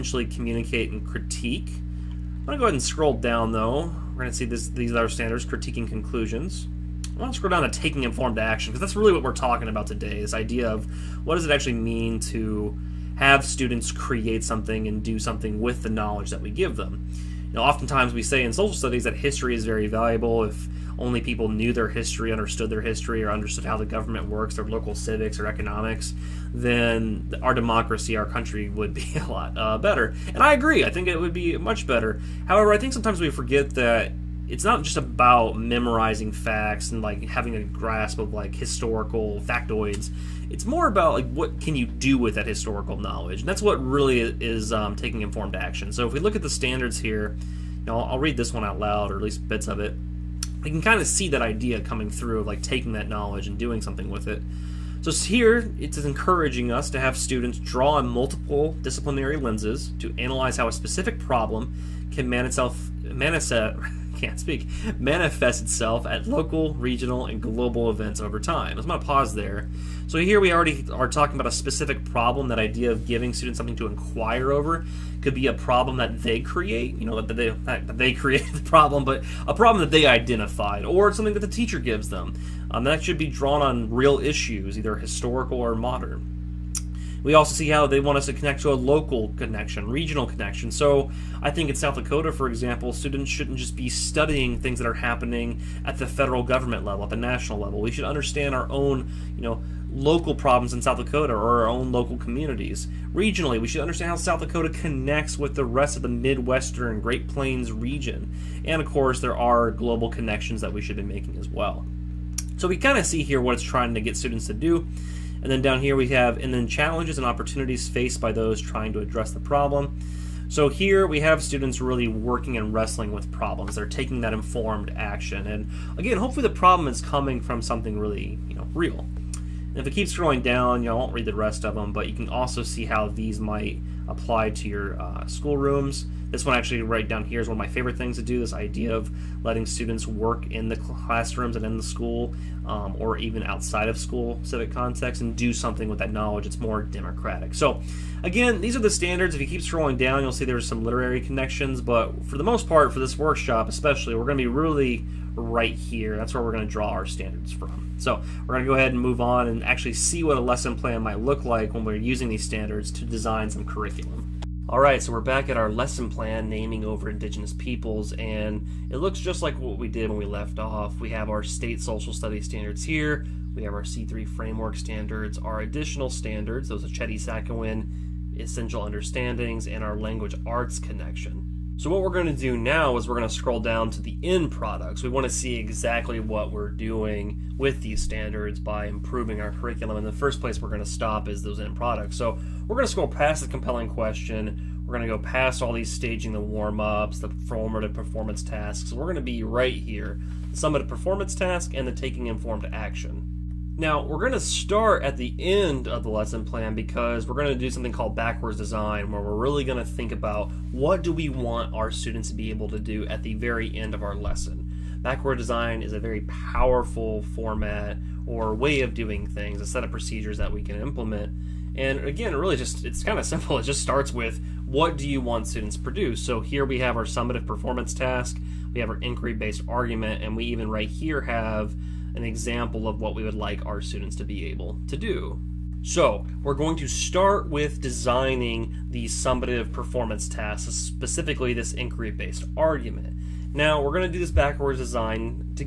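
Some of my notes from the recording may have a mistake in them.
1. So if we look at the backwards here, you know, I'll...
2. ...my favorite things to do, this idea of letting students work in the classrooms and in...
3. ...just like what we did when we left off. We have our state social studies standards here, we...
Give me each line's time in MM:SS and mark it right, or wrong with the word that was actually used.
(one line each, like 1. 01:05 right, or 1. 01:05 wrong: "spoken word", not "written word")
1. 00:45 wrong: "standards", not "backwards"
2. 02:17 right
3. 02:49 right.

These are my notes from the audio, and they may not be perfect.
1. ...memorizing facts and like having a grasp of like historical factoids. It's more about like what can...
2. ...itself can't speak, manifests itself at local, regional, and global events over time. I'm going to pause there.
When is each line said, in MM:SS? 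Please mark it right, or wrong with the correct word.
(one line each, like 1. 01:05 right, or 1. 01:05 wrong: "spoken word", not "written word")
1. 00:35 right
2. 01:03 right.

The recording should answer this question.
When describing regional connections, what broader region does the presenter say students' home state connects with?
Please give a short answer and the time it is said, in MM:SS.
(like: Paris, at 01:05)
Midwestern Great Plains, at 01:46.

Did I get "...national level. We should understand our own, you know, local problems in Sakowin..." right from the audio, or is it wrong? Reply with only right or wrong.
wrong.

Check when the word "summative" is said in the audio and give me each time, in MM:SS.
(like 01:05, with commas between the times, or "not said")
03:20, 03:47, 03:59.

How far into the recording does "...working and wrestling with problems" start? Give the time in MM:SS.
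02:02.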